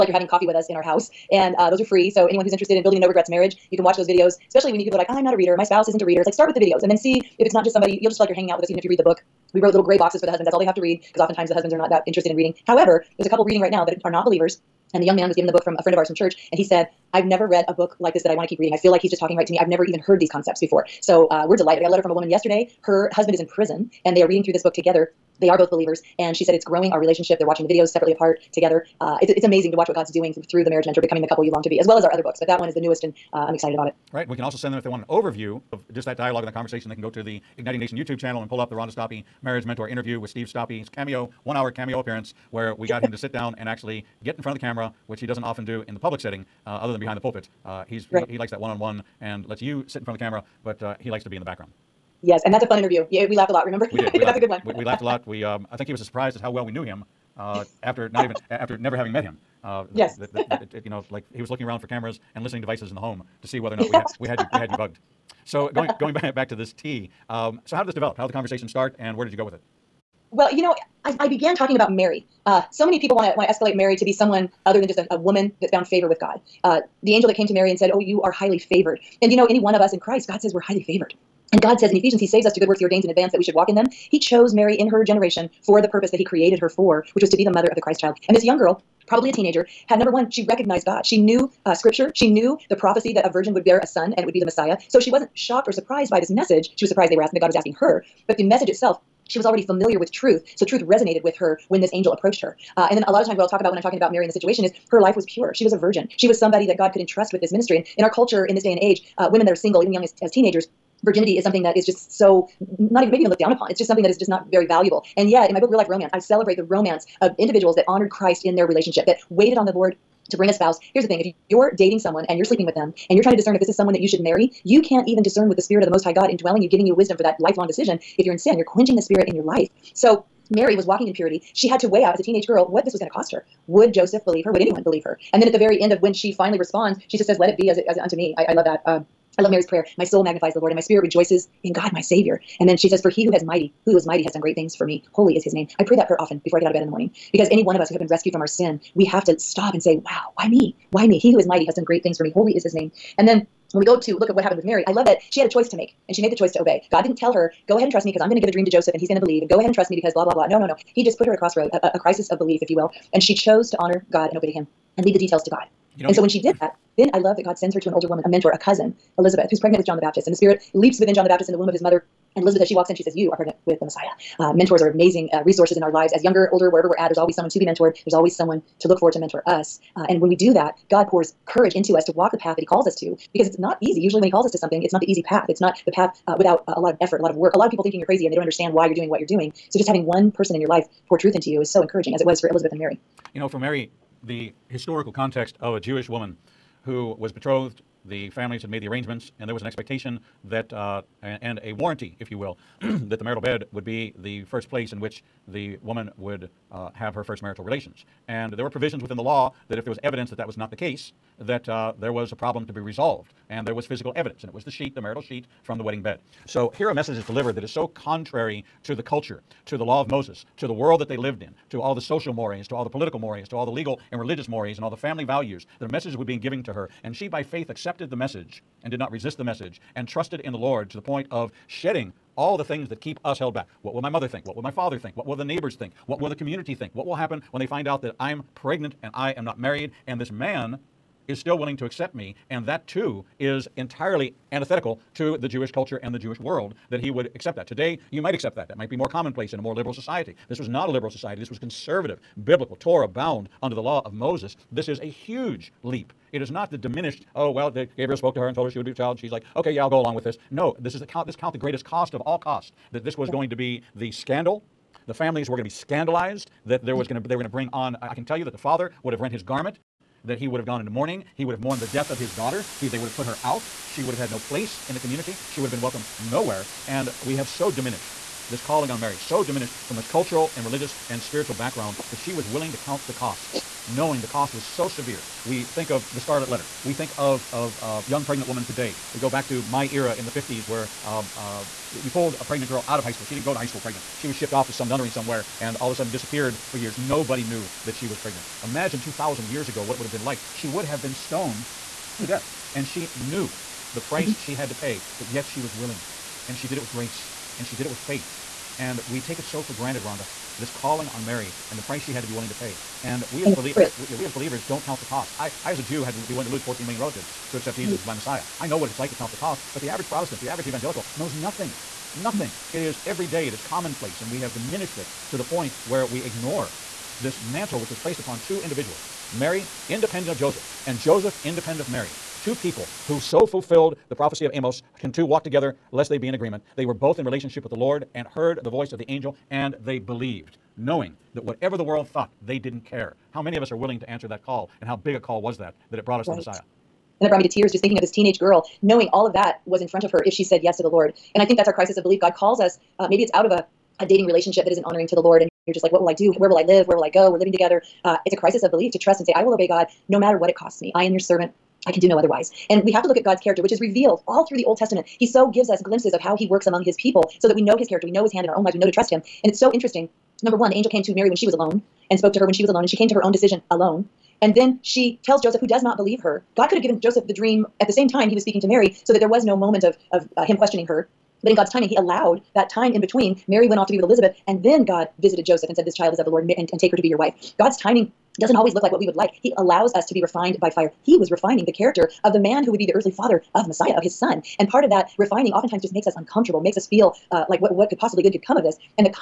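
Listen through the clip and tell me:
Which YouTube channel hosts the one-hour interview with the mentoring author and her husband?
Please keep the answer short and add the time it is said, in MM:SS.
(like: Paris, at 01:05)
Igniting Nation, at 00:37.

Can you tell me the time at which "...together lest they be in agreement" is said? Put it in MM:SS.
05:35.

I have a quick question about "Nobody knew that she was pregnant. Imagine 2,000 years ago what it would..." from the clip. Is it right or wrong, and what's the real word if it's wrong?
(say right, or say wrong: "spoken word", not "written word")
right.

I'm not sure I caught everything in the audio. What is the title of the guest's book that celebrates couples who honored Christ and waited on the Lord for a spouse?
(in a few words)
Real Life Romance.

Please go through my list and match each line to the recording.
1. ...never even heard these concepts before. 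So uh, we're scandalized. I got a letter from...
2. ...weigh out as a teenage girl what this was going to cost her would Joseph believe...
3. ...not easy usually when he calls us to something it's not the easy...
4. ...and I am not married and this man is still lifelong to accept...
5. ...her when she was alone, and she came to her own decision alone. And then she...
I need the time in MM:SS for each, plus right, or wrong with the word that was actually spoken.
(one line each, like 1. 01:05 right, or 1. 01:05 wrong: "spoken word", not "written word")
1. 00:19 wrong: "delighted", not "scandalized"
2. 02:11 right
3. 03:03 right
4. 03:59 wrong: "willing", not "lifelong"
5. 06:12 right.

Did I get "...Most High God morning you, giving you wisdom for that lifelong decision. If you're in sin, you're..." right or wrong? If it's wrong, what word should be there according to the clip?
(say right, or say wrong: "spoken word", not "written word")
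wrong: "indwelling", not "morning".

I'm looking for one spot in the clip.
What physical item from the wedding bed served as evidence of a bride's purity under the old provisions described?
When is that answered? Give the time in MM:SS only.
03:34.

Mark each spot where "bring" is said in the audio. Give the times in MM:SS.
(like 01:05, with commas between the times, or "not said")
02:00, 04:27.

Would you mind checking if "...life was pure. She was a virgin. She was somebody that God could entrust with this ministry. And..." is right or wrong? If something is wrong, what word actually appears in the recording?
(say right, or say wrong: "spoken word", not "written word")
right.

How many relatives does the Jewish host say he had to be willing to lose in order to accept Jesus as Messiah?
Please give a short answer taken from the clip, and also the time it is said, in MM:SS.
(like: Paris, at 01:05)
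14 million, at 05:16.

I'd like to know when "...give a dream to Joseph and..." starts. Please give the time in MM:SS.
02:38.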